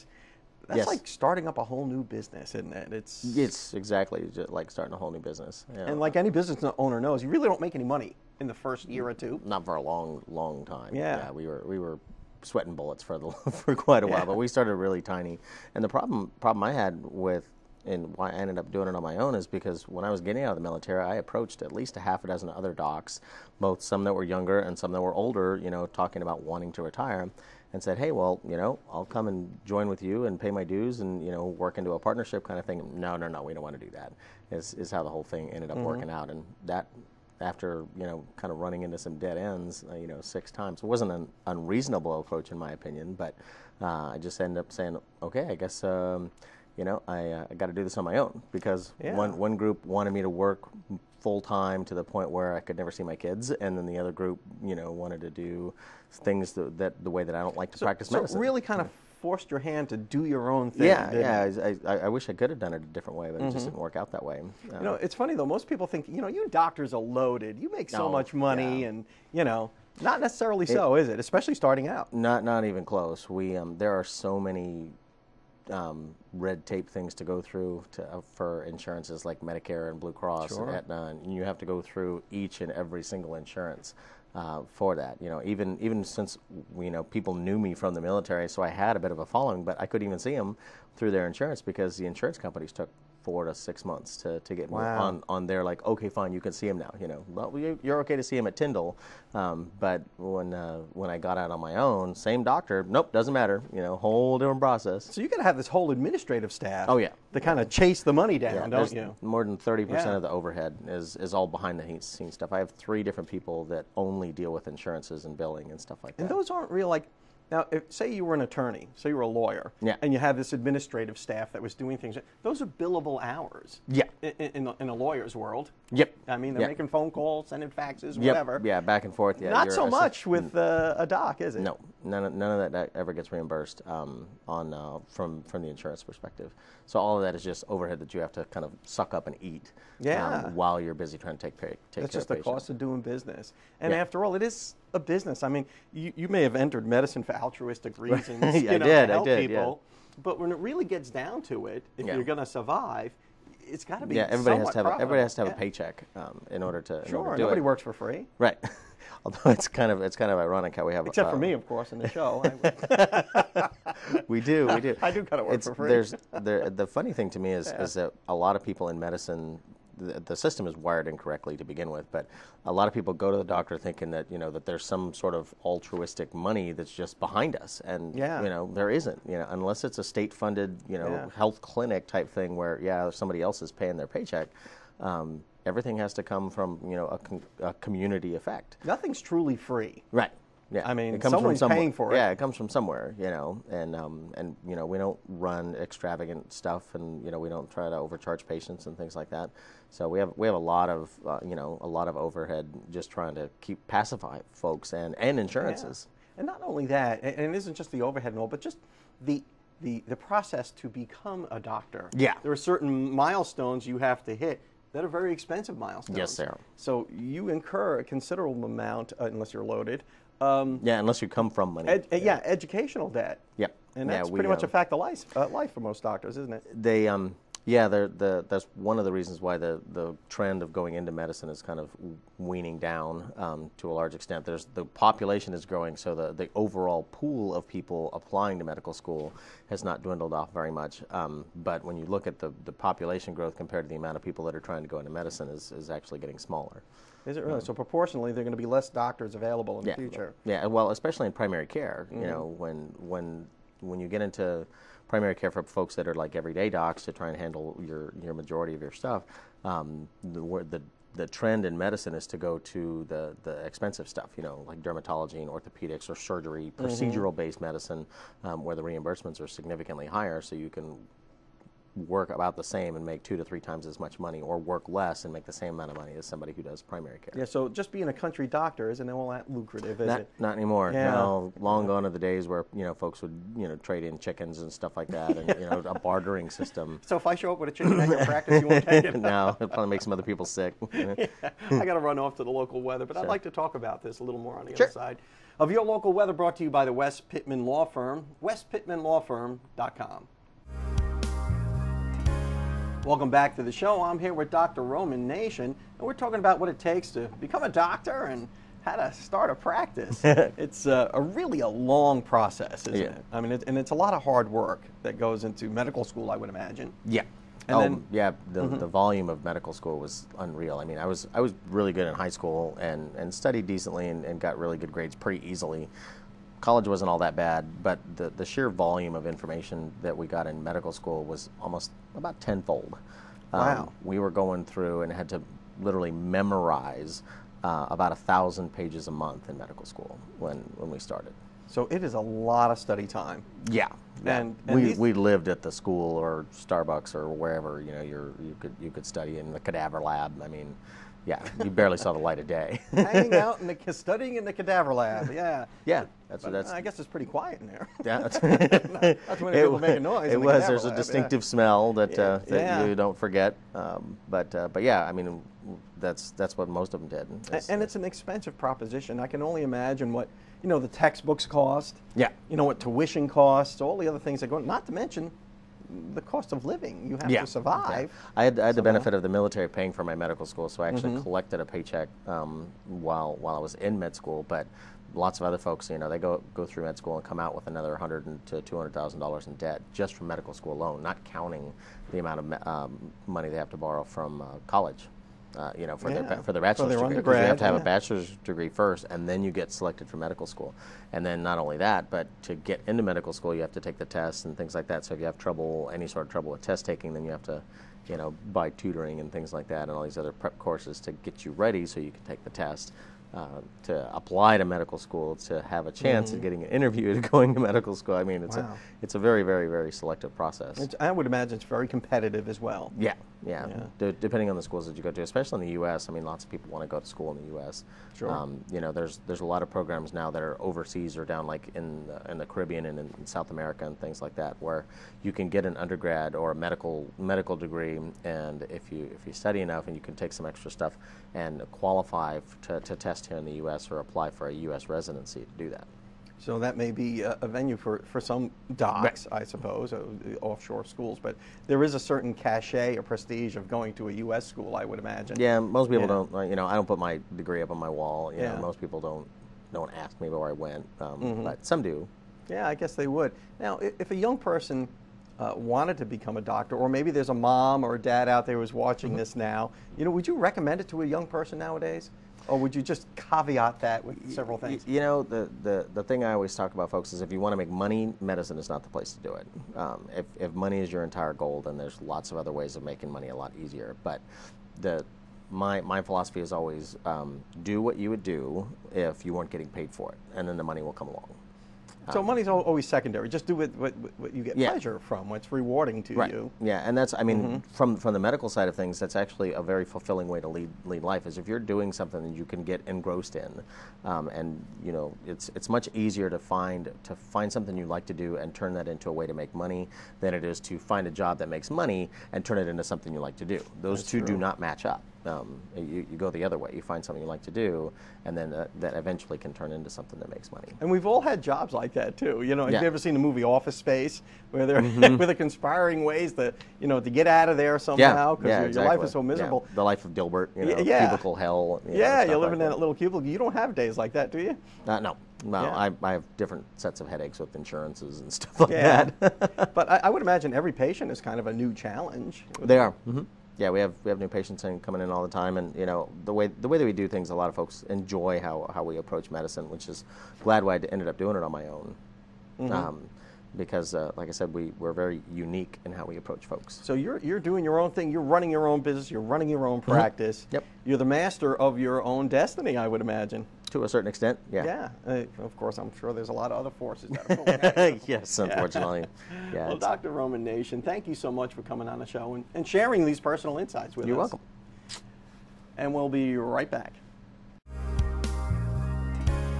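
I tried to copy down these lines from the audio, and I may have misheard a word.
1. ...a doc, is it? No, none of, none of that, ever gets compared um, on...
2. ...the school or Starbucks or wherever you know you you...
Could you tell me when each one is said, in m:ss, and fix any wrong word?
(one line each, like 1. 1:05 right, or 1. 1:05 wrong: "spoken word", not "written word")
1. 2:10 wrong: "reimbursed", not "compared"
2. 5:45 right.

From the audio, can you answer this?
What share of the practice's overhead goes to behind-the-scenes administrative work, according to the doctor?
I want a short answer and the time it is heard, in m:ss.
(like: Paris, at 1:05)
more than 30 percent, at 1:49.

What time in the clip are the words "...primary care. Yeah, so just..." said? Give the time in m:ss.
4:36.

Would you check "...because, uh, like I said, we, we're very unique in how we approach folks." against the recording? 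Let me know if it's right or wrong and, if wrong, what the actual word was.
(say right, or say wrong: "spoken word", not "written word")
right.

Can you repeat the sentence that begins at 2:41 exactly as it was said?
Except for um, me, of course, in the show.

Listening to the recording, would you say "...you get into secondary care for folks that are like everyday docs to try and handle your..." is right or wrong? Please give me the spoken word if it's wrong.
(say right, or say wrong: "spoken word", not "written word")
wrong: "primary", not "secondary".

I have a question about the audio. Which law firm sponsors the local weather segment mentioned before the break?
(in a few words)
West Pittman Law Firm.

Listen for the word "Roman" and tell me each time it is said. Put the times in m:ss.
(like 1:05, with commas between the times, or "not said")
5:04, 9:30.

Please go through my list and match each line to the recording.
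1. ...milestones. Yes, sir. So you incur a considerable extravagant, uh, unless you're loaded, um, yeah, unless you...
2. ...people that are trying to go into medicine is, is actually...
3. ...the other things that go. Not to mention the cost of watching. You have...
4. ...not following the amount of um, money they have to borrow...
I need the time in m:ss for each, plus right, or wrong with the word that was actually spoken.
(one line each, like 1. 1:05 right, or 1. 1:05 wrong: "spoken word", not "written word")
1. 3:35 wrong: "amount", not "extravagant"
2. 4:04 right
3. 6:13 wrong: "living", not "watching"
4. 6:31 wrong: "counting", not "following".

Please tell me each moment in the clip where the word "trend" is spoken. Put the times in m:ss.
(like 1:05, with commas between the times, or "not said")
3:50, 4:21.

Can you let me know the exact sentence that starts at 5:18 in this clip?
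the volume of medical school was unreal.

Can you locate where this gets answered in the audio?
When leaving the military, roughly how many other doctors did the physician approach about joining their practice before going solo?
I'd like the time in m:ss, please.
0:21.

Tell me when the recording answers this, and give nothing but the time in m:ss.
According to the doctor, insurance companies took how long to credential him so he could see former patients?
1:33.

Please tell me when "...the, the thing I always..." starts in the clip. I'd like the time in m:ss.
7:55.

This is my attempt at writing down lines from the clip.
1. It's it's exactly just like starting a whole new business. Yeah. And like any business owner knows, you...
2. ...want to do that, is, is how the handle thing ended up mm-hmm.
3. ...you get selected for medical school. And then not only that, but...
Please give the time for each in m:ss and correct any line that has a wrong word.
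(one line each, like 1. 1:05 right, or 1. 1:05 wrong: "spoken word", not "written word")
1. 0:02 right
2. 0:33 wrong: "whole", not "handle"
3. 6:39 right.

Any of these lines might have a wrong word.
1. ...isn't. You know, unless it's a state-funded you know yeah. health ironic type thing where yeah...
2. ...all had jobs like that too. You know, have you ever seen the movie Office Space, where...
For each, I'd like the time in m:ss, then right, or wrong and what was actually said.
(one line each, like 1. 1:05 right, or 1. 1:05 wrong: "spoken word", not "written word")
1. 2:58 wrong: "clinic", not "ironic"
2. 8:41 right.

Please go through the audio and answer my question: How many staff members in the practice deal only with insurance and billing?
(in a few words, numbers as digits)
3.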